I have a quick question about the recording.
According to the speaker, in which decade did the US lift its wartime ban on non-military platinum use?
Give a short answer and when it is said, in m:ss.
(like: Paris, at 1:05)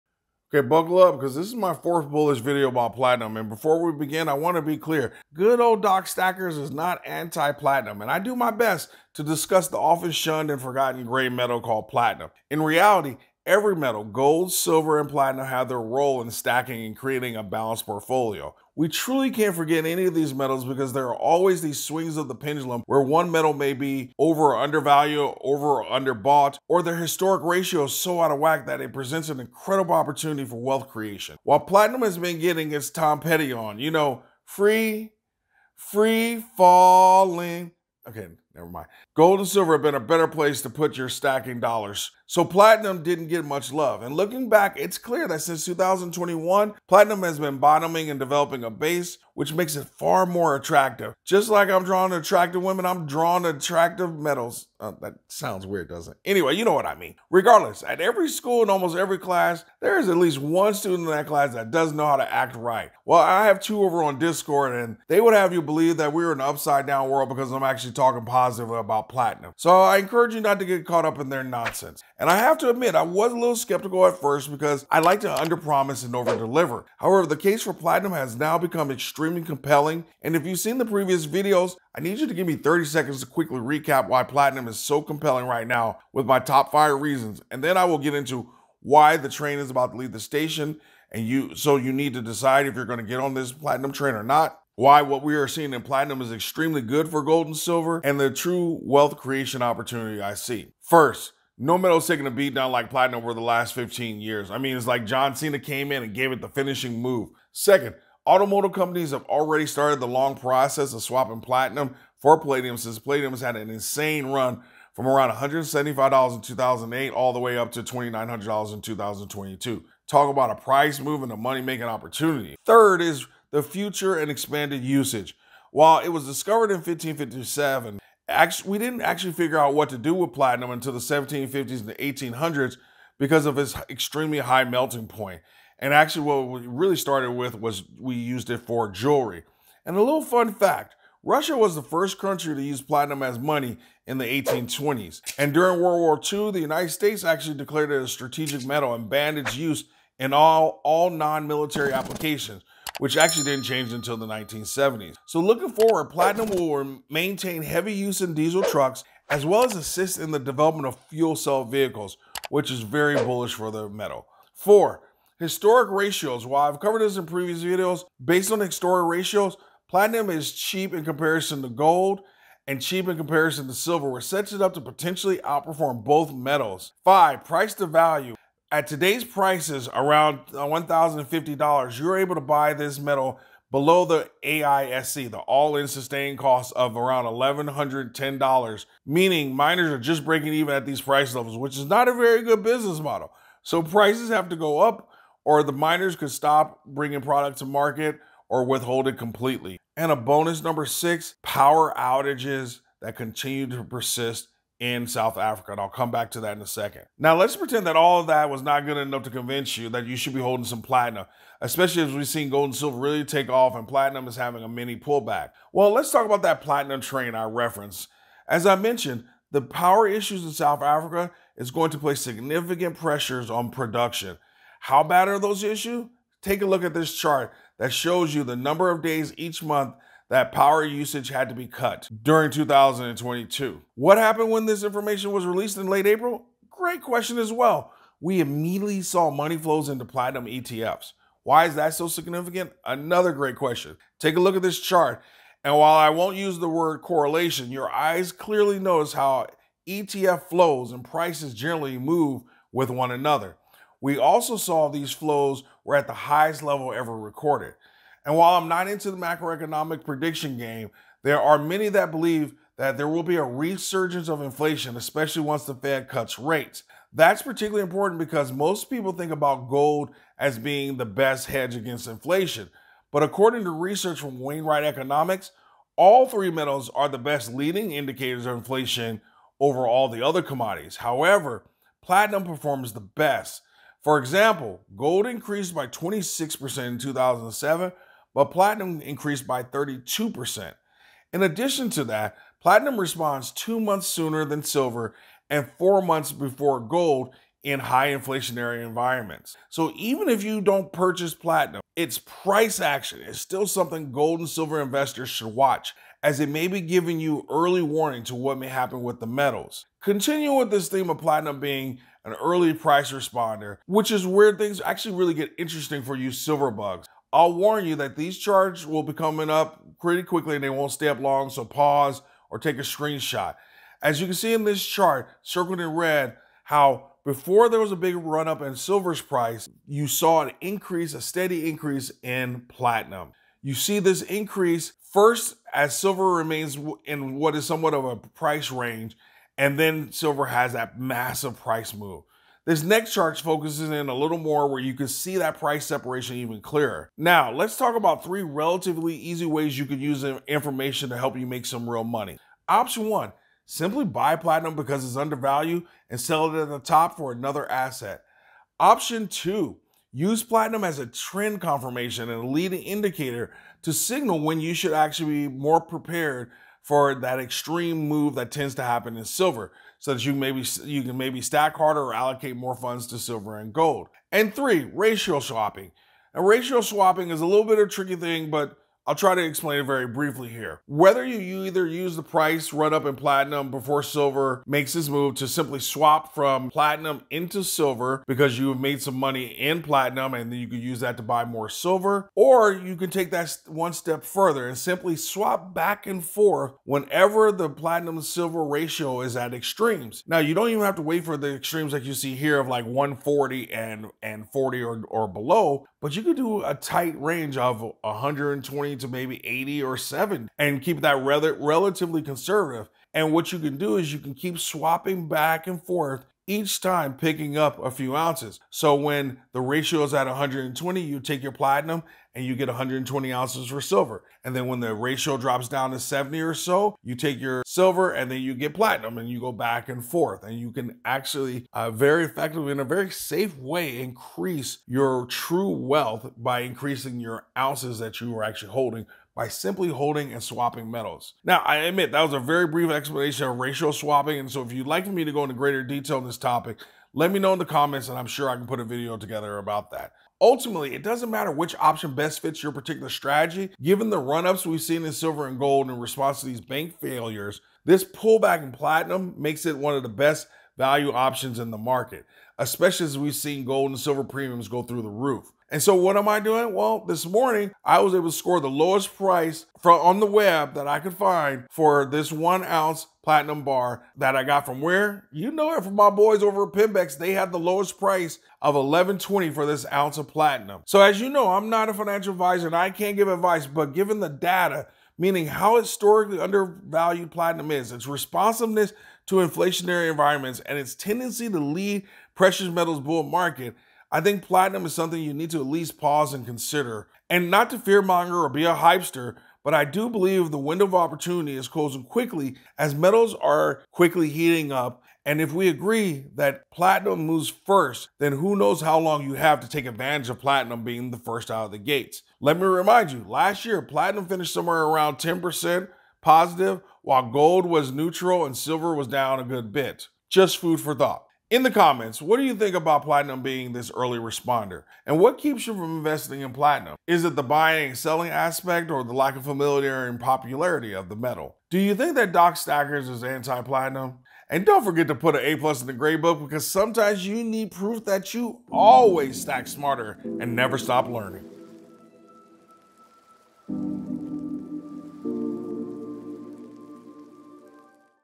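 1970s, at 2:34.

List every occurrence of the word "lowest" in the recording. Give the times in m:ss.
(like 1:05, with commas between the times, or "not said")
7:48, 7:57.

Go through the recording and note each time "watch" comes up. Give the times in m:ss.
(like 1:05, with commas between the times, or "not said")
5:05.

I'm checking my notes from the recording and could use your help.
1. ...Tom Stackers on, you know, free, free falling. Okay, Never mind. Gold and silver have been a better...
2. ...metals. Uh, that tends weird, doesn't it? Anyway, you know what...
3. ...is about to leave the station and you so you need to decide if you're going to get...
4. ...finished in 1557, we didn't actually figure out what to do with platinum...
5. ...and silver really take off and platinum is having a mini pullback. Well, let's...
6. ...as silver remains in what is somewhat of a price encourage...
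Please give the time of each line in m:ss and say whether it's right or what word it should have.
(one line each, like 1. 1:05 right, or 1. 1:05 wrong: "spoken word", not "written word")
1. 0:32 wrong: "Petty", not "Stackers"
2. 0:54 wrong: "sounds", not "tends"
3. 1:29 right
4. 2:06 wrong: "discovered", not "finished"
5. 3:32 right
6. 5:35 wrong: "range", not "encourage".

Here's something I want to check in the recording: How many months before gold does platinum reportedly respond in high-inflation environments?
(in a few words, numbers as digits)
4 months.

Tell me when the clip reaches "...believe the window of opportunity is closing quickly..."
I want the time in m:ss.
8:20.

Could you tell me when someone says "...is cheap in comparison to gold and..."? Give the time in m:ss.
2:50.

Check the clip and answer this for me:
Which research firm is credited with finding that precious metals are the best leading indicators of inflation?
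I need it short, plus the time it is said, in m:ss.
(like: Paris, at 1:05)
Wainwright Economics, at 4:34.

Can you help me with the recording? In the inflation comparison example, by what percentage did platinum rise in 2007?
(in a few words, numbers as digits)
32%.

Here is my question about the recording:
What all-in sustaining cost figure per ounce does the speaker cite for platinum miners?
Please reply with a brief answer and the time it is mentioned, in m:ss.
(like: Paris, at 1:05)
$1,110, at 3:07.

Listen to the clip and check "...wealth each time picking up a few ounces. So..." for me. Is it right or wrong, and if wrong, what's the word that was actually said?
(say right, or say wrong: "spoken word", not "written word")
wrong: "forth", not "wealth".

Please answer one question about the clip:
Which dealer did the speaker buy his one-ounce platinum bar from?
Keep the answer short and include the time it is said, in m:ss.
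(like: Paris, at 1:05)
Pimbex, at 7:56.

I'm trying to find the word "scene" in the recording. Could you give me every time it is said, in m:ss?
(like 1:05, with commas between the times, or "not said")
not said.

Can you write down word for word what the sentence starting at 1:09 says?
So I encourage you not to get caught up in their nonsense.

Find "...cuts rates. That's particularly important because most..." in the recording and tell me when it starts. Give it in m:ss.
4:26.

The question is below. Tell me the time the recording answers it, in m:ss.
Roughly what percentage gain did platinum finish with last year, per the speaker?
8:35.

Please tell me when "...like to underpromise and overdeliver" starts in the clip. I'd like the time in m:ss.
1:14.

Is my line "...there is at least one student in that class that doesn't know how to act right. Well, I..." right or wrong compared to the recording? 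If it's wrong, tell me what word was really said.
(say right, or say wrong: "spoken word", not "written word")
right.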